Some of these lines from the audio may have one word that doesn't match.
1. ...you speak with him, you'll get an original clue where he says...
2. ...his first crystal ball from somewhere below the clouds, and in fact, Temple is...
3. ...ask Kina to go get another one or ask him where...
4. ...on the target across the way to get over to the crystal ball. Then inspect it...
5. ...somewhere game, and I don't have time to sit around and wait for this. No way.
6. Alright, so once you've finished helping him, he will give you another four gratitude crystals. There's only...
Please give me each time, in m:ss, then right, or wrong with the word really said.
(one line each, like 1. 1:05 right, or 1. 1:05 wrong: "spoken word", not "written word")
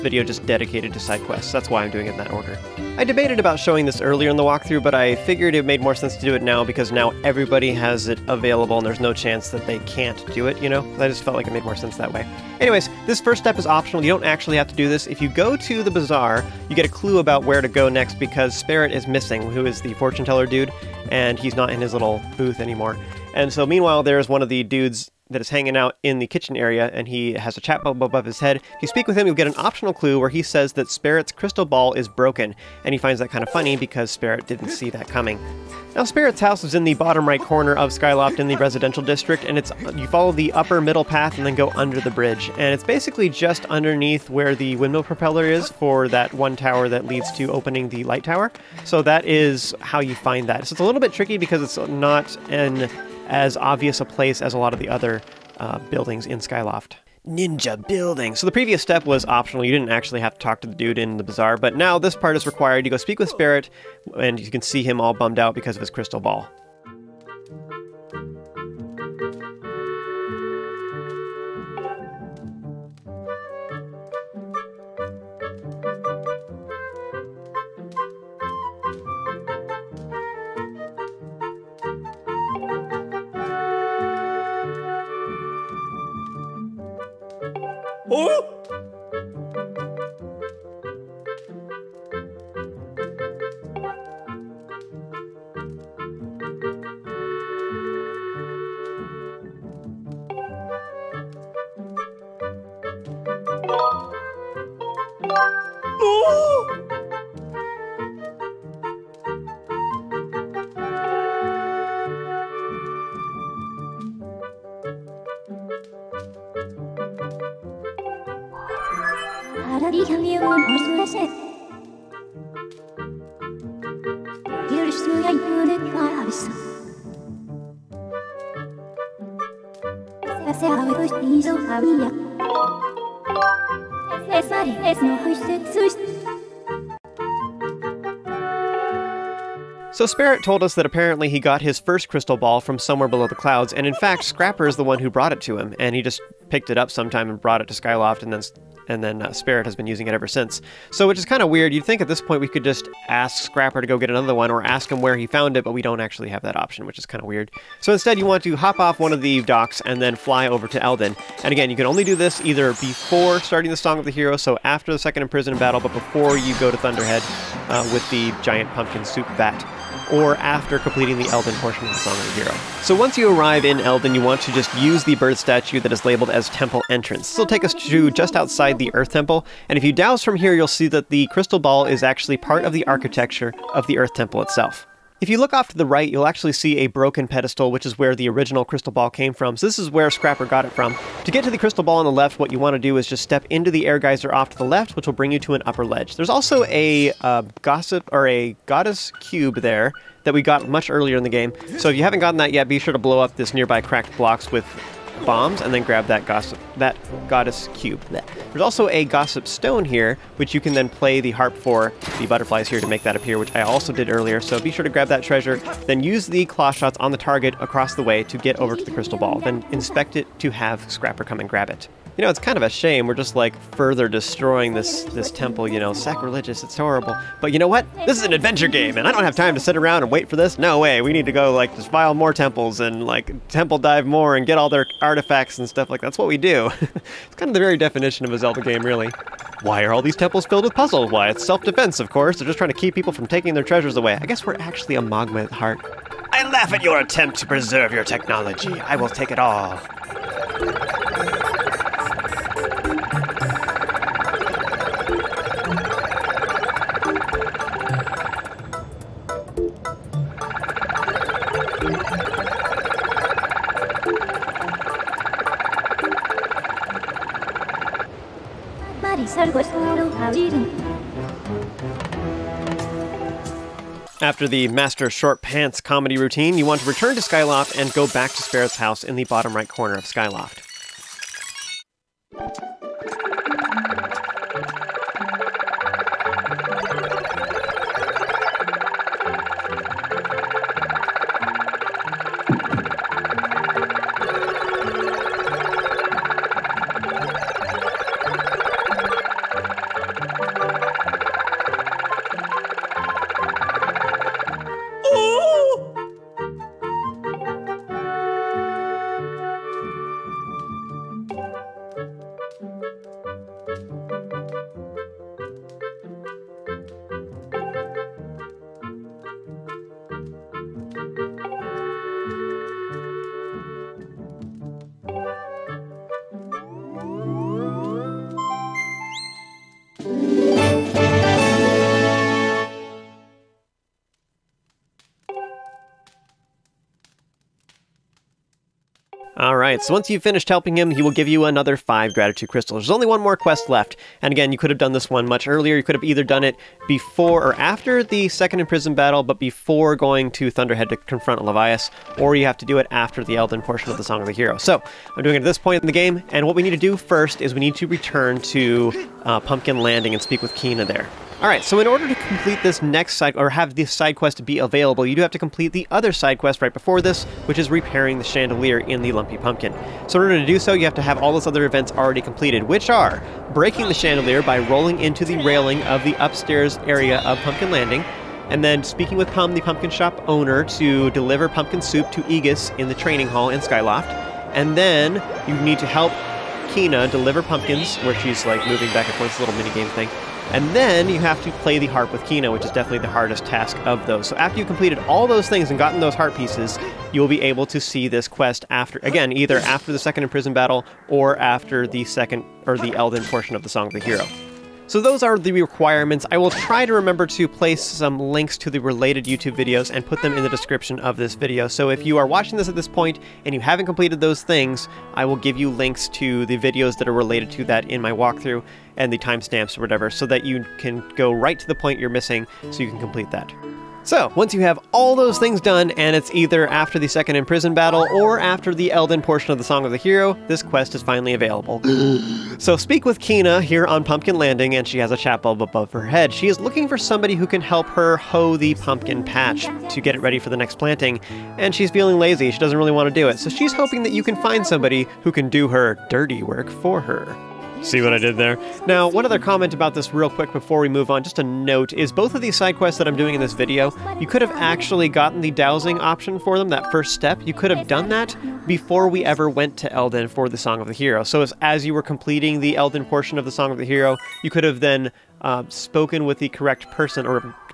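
1. 0:28 wrong: "optional", not "original"
2. 2:21 wrong: "Scrapper", not "Temple"
3. 2:33 wrong: "Scrapper", not "Kina"
4. 3:36 right
5. 3:48 wrong: "adventure", not "somewhere"
6. 5:39 wrong: "five", not "four".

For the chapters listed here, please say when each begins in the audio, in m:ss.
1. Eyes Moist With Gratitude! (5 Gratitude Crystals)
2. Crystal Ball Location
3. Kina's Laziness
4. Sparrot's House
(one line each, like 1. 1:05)
1. 4:33
2. 2:38
3. 6:01
4. 0:32.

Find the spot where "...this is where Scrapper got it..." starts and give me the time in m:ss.
3:09.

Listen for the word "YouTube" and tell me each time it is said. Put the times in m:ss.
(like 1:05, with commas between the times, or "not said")
6:49.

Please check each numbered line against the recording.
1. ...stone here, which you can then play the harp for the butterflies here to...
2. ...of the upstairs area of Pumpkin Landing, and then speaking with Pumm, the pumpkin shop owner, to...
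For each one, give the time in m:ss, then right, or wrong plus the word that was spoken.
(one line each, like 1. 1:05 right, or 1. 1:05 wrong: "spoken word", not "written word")
1. 3:29 right
2. 6:15 right.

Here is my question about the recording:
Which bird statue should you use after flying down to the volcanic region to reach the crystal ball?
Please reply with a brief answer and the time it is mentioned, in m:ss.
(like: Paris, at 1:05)
Temple Entrance, at 2:56.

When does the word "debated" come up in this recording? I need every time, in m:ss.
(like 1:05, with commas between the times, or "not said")
0:03.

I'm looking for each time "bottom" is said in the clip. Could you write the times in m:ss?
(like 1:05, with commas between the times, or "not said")
0:36, 4:39.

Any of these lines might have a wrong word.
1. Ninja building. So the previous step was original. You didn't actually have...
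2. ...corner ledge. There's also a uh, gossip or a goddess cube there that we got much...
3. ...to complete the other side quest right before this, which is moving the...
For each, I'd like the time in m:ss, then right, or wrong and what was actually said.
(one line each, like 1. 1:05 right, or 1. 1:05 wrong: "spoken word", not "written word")
1. 0:57 wrong: "optional", not "original"
2. 3:15 wrong: "upper", not "corner"
3. 6:05 wrong: "repairing", not "moving".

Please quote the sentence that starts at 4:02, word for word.
They're just trying to keep people from taking their treasures away.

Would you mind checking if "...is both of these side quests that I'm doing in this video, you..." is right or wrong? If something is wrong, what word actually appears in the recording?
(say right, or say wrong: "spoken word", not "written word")
right.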